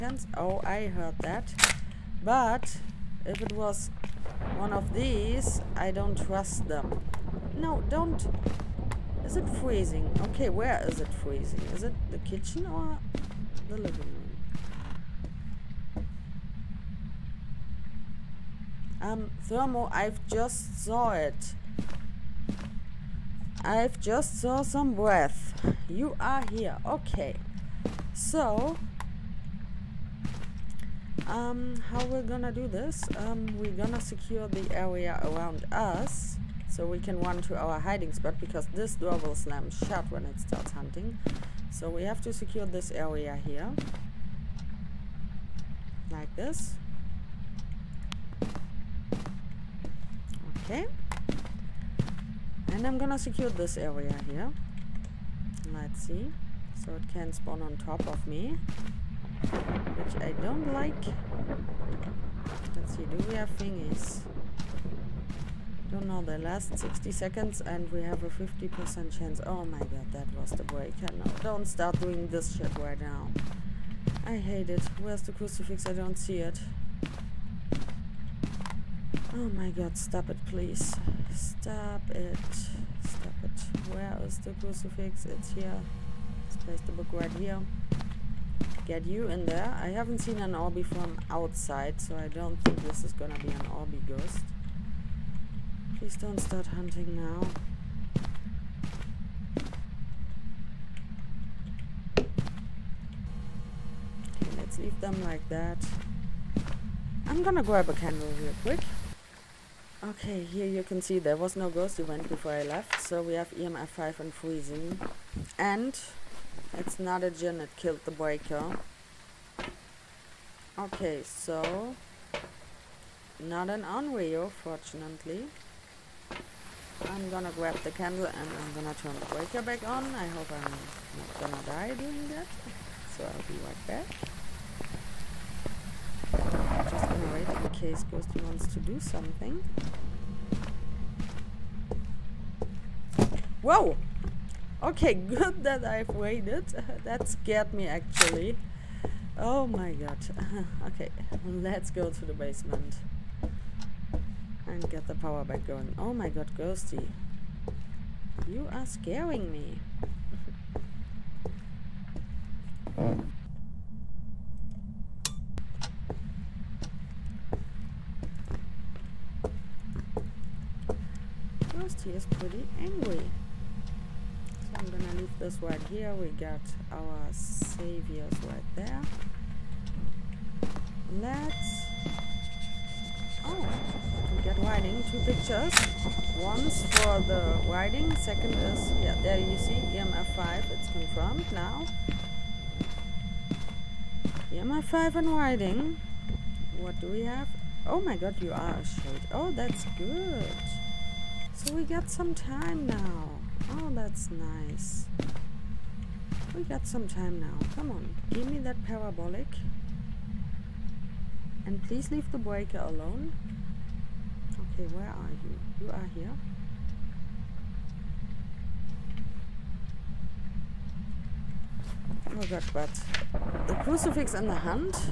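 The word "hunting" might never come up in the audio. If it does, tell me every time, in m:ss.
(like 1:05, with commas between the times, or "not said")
0:40, 1:36.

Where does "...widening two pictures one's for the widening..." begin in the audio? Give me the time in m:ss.
3:04.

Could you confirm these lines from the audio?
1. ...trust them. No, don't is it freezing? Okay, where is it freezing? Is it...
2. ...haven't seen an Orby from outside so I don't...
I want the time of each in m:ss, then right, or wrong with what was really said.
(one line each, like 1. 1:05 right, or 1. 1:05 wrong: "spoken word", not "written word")
1. 0:06 right
2. 1:29 right.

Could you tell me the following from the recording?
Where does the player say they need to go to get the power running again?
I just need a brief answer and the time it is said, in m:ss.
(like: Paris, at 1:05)
The basement, at 2:32.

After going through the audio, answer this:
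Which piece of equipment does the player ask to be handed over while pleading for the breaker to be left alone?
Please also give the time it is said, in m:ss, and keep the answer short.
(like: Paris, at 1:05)
Parabolic, at 3:28.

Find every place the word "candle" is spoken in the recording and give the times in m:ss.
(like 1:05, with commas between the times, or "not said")
1:47, 2:07.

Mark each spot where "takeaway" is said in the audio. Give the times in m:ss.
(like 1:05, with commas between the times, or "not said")
not said.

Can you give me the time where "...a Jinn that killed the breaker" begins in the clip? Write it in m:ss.
1:57.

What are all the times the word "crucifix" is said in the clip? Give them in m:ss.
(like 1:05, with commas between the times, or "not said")
1:15, 1:24, 3:43.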